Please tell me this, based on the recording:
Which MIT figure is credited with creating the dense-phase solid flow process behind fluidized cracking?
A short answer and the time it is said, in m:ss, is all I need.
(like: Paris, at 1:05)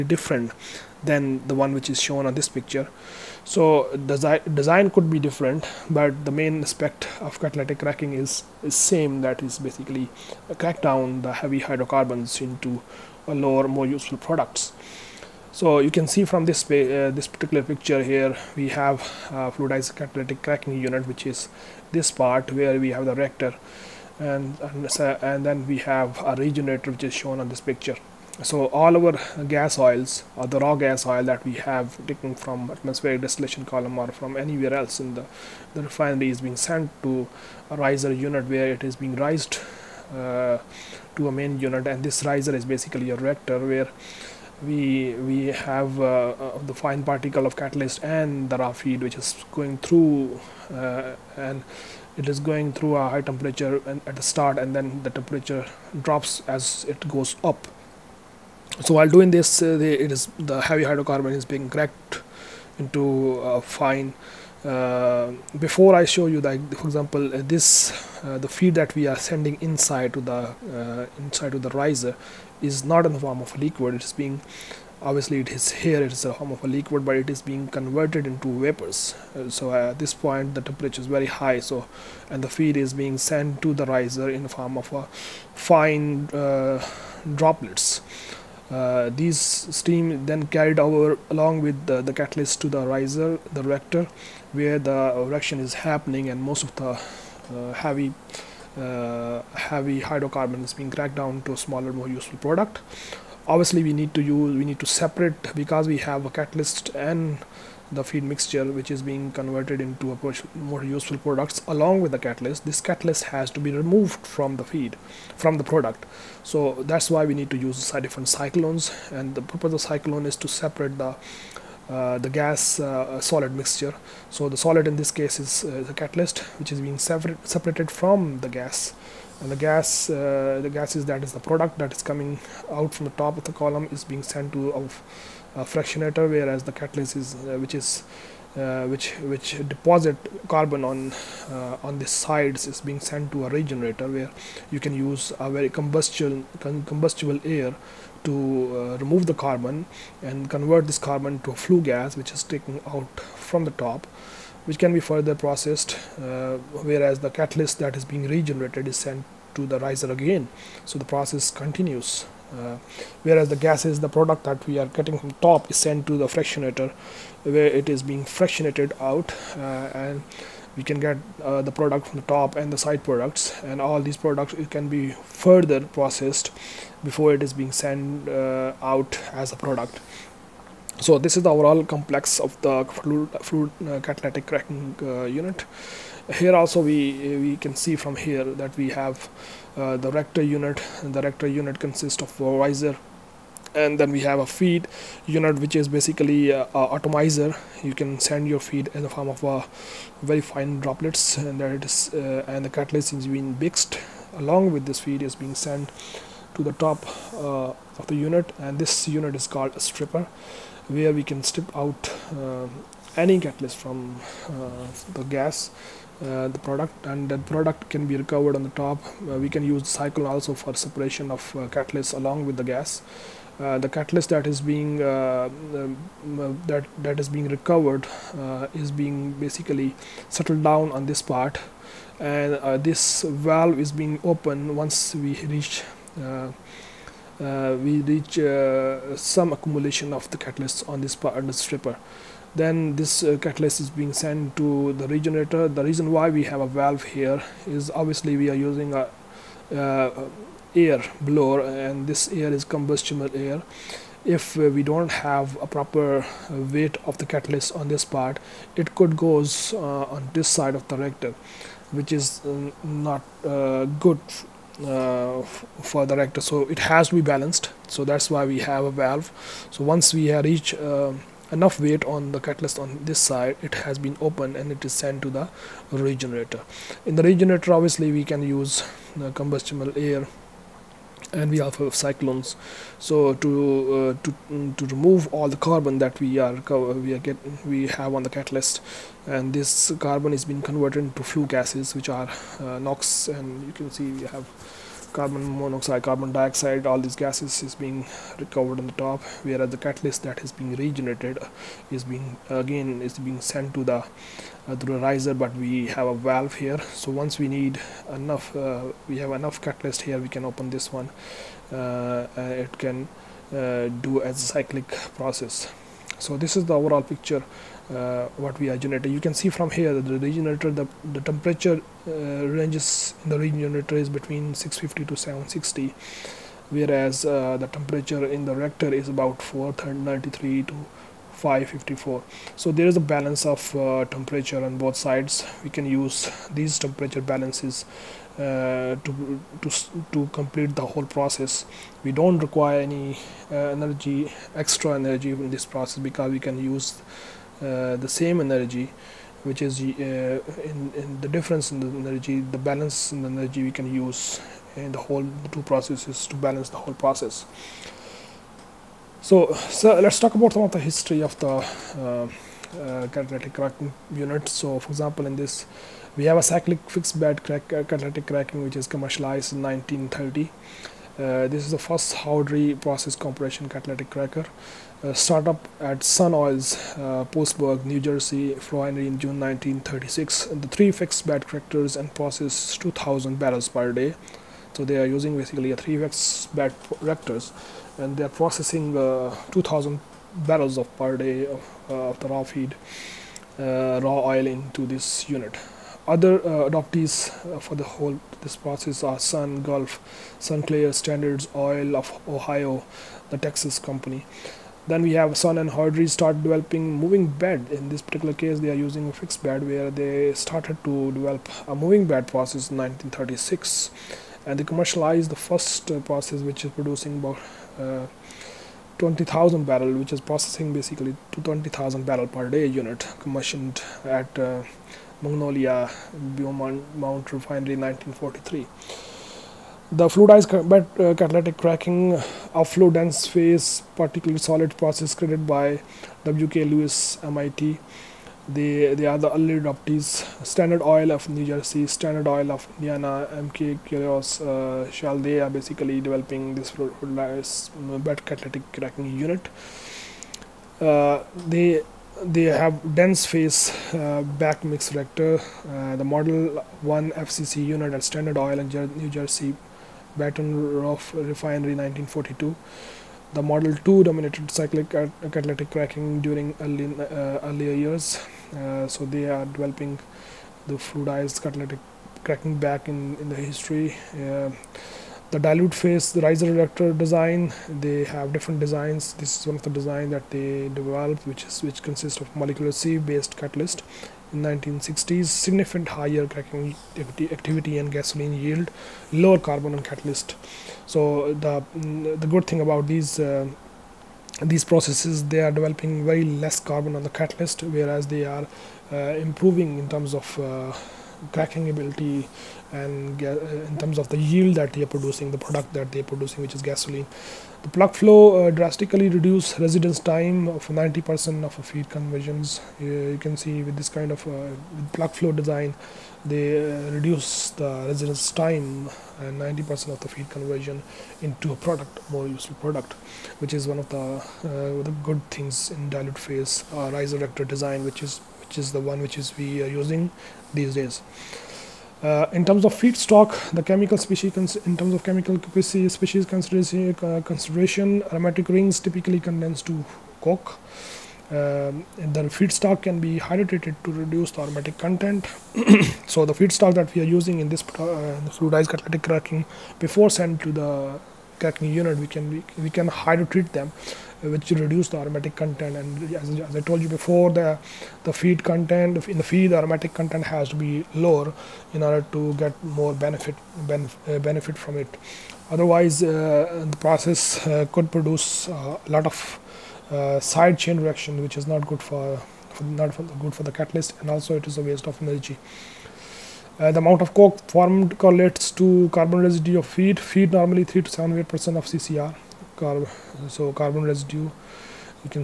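W.K. Lewis, at 7:16.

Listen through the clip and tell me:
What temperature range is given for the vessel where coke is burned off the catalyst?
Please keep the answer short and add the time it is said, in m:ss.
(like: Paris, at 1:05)
650 to 760, at 5:24.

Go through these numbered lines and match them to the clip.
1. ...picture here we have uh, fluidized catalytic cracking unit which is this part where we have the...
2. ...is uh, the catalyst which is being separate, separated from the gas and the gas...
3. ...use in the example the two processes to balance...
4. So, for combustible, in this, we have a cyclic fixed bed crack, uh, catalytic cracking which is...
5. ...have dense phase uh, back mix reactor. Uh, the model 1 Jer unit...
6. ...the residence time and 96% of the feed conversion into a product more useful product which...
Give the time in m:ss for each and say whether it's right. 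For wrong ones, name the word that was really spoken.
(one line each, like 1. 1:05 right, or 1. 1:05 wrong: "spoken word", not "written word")
1. 0:17 right
2. 2:05 right
3. 5:53 wrong: "whole", not "example"
4. 6:04 wrong: "example", not "combustible"
5. 7:32 wrong: "FCC", not "Jer"
6. 8:37 wrong: "90", not "96".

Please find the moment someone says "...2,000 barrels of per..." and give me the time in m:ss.
6:29.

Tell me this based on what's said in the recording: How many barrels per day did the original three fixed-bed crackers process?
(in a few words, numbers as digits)
2,000.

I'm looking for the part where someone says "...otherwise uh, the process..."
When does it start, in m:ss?
9:25.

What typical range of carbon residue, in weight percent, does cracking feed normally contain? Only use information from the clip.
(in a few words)
3 to 7.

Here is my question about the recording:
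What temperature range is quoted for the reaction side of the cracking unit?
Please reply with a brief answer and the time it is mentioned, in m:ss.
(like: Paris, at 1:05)
493 to 554, at 5:29.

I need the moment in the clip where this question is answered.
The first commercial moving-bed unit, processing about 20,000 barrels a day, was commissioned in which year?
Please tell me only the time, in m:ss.
7:07.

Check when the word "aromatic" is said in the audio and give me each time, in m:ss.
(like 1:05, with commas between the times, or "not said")
8:58, 9:04, 9:14, 9:19.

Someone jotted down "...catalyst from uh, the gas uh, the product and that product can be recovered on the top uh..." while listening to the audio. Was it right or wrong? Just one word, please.
right.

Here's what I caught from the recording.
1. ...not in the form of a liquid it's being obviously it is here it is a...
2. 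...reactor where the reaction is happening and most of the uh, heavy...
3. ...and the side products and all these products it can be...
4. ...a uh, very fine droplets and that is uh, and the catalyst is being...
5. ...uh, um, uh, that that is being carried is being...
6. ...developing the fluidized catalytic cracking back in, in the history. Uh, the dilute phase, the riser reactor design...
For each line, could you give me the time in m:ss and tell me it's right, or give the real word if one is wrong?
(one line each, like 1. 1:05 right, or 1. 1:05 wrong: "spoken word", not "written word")
1. 1:12 right
2. 1:33 right
3. 2:52 right
4. 3:19 right
5. 3:45 wrong: "recovered", not "carried"
6. 7:49 right.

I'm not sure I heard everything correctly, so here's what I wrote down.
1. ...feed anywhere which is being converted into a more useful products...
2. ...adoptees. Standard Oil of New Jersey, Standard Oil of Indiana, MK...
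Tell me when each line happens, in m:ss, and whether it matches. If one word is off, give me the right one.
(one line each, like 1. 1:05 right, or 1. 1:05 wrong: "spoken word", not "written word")
1. 1:48 wrong: "mixture", not "anywhere"
2. 7:19 right.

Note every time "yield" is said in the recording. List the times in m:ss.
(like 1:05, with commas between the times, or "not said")
8:08, 8:24.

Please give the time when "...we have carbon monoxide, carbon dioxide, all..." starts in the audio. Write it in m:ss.
4:54.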